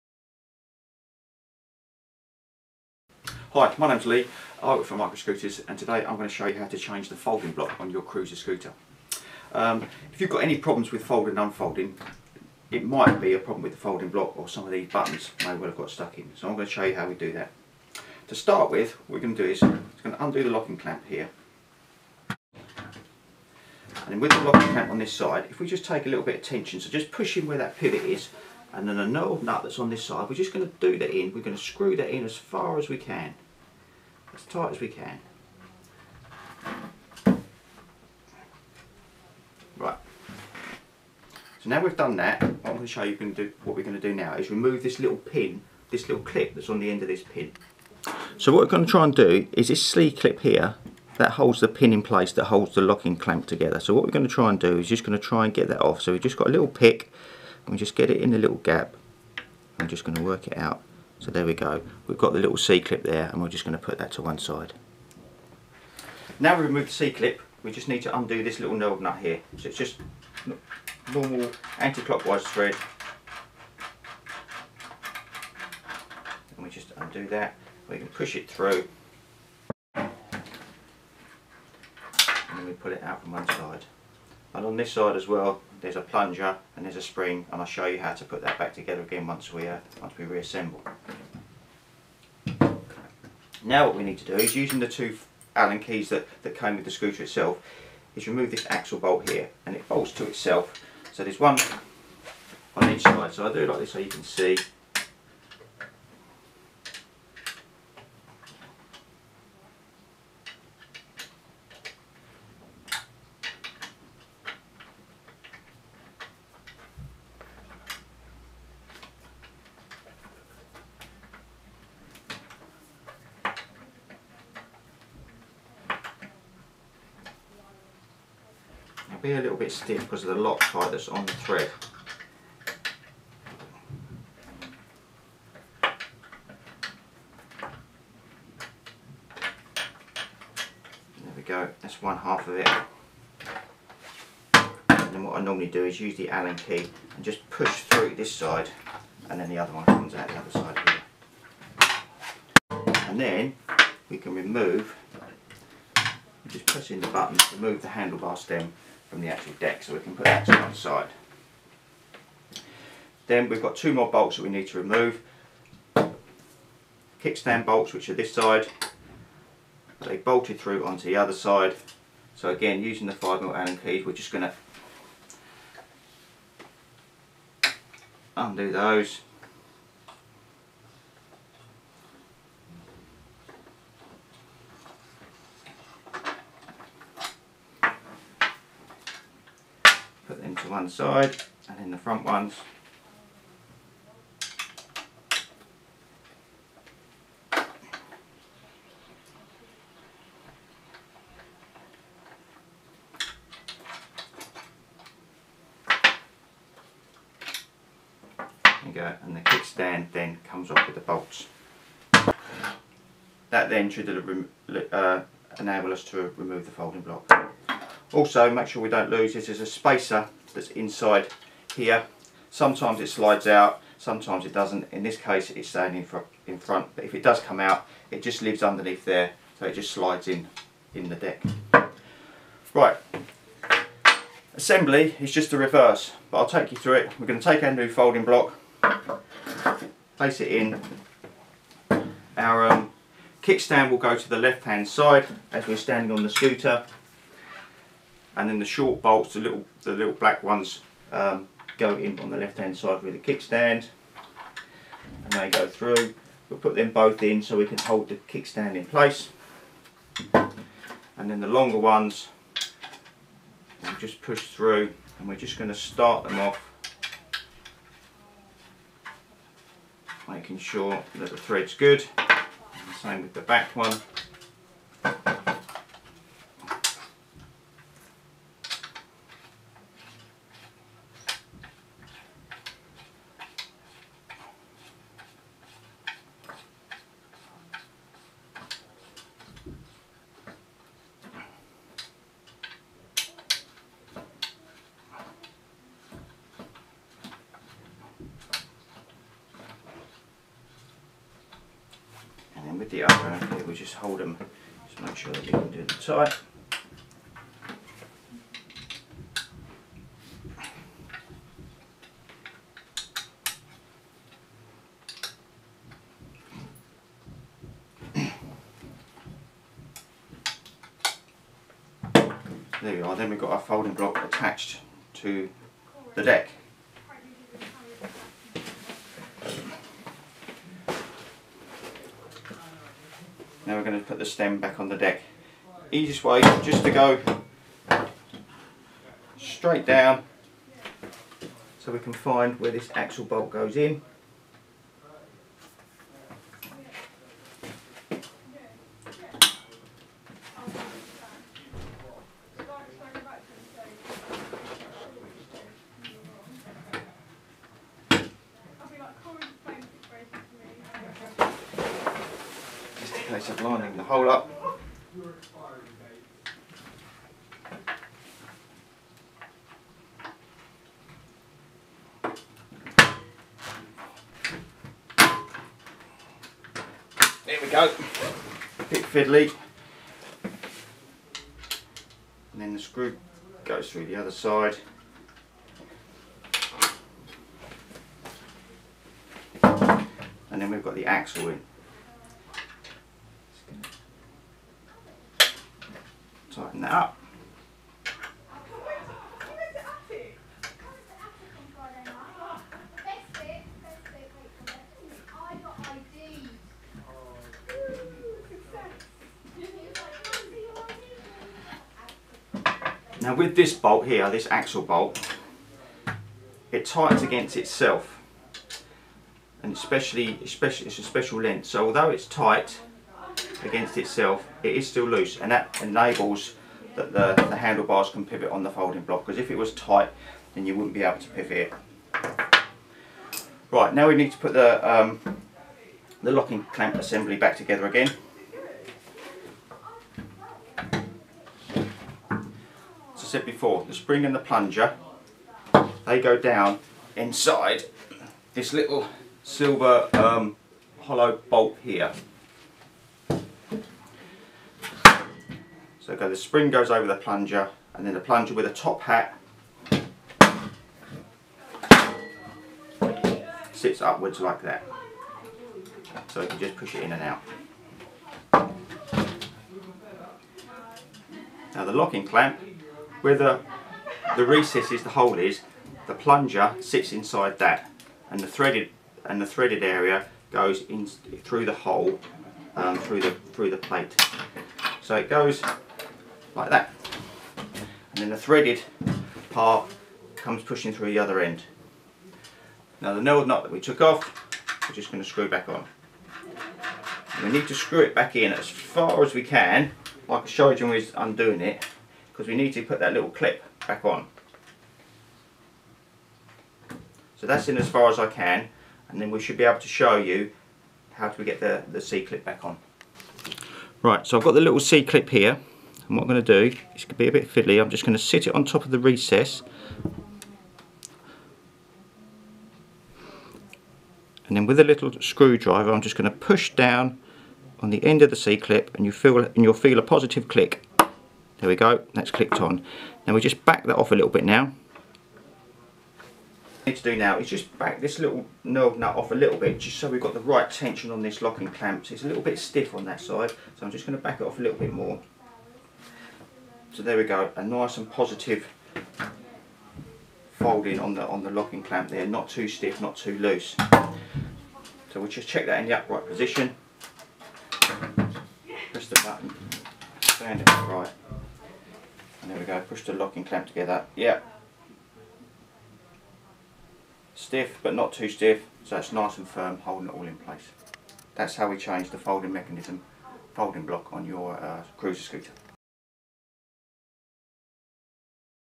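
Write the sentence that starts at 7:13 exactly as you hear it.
Right, now we need to put the, um, the locking clamp assembly back together again.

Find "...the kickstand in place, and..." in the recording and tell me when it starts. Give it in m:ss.
4:18.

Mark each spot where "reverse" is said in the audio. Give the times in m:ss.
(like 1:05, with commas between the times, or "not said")
3:55.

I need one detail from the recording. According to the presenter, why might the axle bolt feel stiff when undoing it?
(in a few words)
Loctite.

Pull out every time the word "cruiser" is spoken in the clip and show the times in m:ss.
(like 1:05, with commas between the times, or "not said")
0:08, 9:34.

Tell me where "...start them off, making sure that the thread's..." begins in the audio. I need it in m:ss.
4:25.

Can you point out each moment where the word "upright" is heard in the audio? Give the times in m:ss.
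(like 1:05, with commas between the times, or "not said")
9:15, 9:20.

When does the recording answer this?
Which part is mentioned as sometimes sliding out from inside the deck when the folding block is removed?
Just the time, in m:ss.
3:39.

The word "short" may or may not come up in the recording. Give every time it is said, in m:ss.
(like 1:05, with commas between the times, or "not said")
4:08.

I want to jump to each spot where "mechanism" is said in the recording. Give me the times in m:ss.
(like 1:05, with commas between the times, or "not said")
9:32.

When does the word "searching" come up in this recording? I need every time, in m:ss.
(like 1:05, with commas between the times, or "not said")
not said.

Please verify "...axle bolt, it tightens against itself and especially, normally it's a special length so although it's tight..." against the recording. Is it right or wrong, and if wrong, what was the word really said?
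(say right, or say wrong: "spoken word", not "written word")
wrong: "especially", not "normally".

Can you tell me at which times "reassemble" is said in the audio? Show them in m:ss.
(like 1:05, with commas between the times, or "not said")
1:30.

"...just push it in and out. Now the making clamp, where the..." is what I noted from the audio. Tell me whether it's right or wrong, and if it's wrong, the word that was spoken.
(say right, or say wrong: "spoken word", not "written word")
wrong: "locking", not "making".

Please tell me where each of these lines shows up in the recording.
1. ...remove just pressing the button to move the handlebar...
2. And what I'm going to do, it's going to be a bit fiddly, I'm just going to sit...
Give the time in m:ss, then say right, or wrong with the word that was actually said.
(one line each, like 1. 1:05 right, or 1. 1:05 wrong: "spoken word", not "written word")
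1. 2:34 right
2. 8:36 right.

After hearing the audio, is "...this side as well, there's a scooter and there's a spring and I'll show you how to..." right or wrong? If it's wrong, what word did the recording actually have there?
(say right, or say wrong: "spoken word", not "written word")
wrong: "plunger", not "scooter".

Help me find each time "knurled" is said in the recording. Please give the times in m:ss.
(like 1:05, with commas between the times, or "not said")
0:29, 8:13.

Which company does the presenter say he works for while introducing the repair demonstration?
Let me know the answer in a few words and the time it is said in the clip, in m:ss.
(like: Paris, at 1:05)
Micro Scooters, at 0:04.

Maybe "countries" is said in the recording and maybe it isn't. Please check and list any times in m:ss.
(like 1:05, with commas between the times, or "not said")
not said.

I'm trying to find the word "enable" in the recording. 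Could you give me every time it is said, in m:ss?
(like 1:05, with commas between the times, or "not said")
3:35, 7:05.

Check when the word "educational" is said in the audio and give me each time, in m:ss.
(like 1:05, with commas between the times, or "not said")
not said.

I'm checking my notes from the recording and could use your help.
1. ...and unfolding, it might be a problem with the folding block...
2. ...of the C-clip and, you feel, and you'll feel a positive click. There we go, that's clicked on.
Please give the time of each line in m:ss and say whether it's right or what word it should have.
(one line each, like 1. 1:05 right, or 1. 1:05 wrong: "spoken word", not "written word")
1. 0:11 right
2. 8:48 right.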